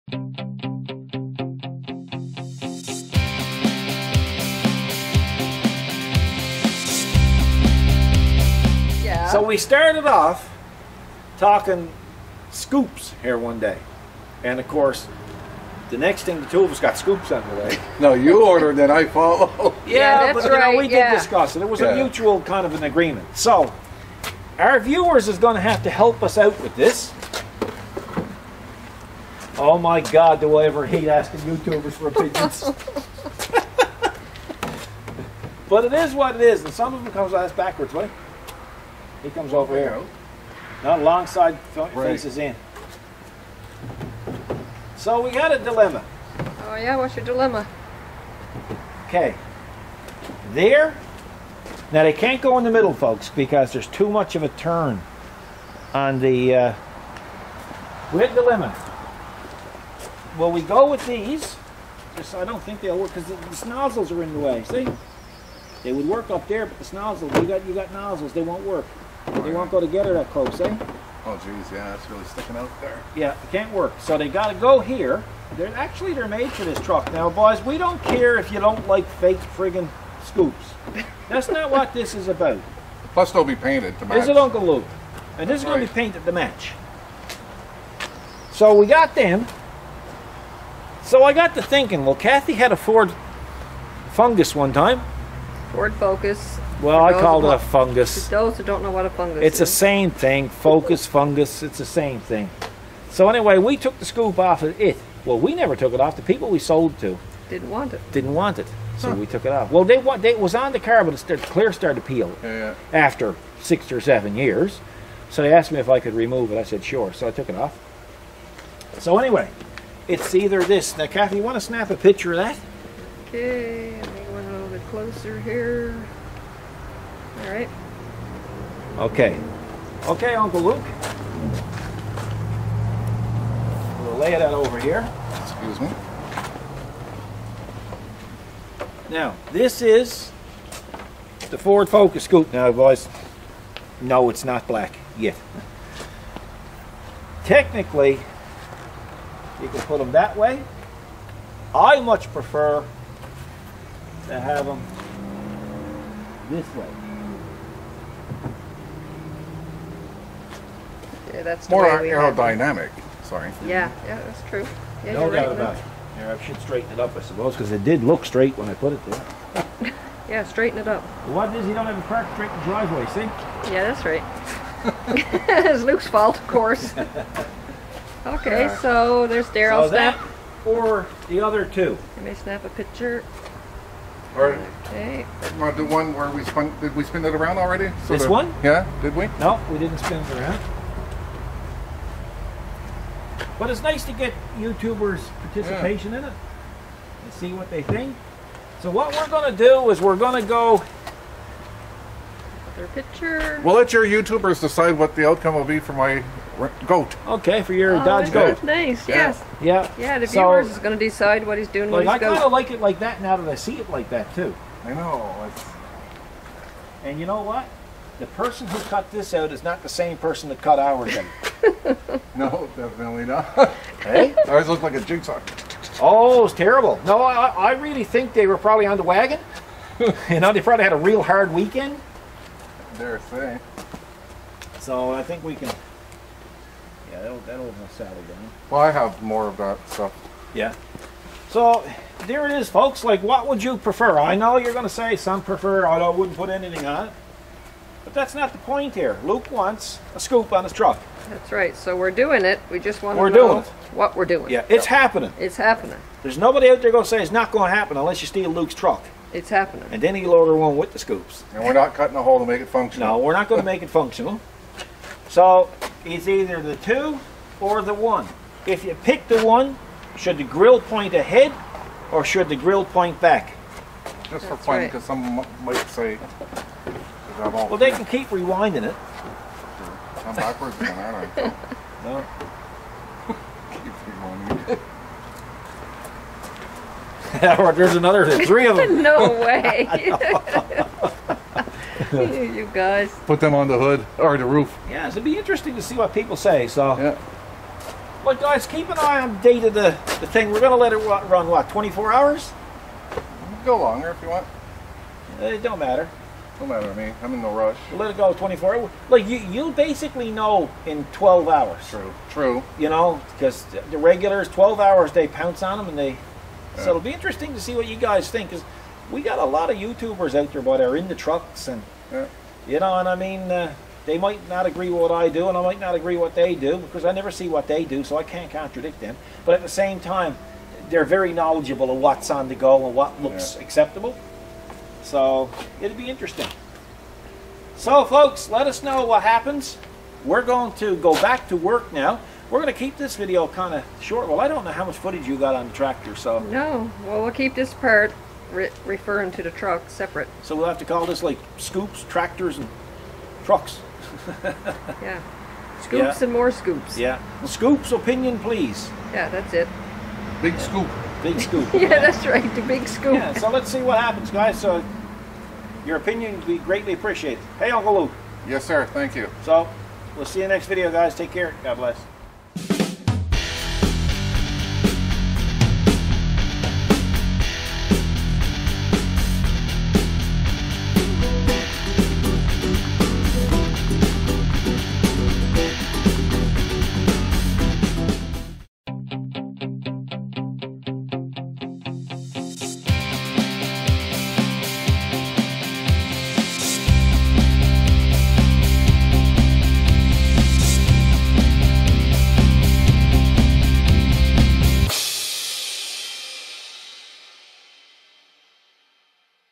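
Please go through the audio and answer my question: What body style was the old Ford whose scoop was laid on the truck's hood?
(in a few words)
Coupe.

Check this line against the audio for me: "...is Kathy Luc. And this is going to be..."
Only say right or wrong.
wrong.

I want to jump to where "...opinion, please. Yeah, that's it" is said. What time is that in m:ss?
5:57.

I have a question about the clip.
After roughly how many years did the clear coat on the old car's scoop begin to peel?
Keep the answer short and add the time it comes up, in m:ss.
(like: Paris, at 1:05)
6 or 7, at 1:53.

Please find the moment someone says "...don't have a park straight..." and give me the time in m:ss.
2:51.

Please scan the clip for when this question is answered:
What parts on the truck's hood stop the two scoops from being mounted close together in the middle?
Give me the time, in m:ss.
1:07.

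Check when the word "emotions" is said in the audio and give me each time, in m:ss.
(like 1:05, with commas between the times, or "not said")
not said.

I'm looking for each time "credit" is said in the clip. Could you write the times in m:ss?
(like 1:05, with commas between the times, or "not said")
not said.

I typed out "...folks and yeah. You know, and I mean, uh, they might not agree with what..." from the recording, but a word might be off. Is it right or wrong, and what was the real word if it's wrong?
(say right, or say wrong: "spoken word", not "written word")
wrong: "trucks", not "folks".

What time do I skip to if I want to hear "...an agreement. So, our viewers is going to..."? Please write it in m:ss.
0:22.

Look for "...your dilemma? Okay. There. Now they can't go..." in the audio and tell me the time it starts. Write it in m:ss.
0:47.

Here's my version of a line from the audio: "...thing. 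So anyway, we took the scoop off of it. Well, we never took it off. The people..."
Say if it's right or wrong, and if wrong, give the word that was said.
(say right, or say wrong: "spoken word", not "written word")
right.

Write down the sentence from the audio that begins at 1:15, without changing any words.
They're Actually, they're made for this truck.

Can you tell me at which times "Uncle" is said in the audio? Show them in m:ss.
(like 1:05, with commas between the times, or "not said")
1:24, 2:10, 6:07.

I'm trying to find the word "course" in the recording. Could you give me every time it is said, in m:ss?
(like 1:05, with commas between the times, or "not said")
0:14, 2:56.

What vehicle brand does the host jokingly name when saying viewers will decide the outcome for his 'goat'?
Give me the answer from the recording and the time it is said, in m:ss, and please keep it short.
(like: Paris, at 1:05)
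Dodge, at 3:28.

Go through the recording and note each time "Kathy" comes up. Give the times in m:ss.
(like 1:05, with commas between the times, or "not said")
1:32, 2:01.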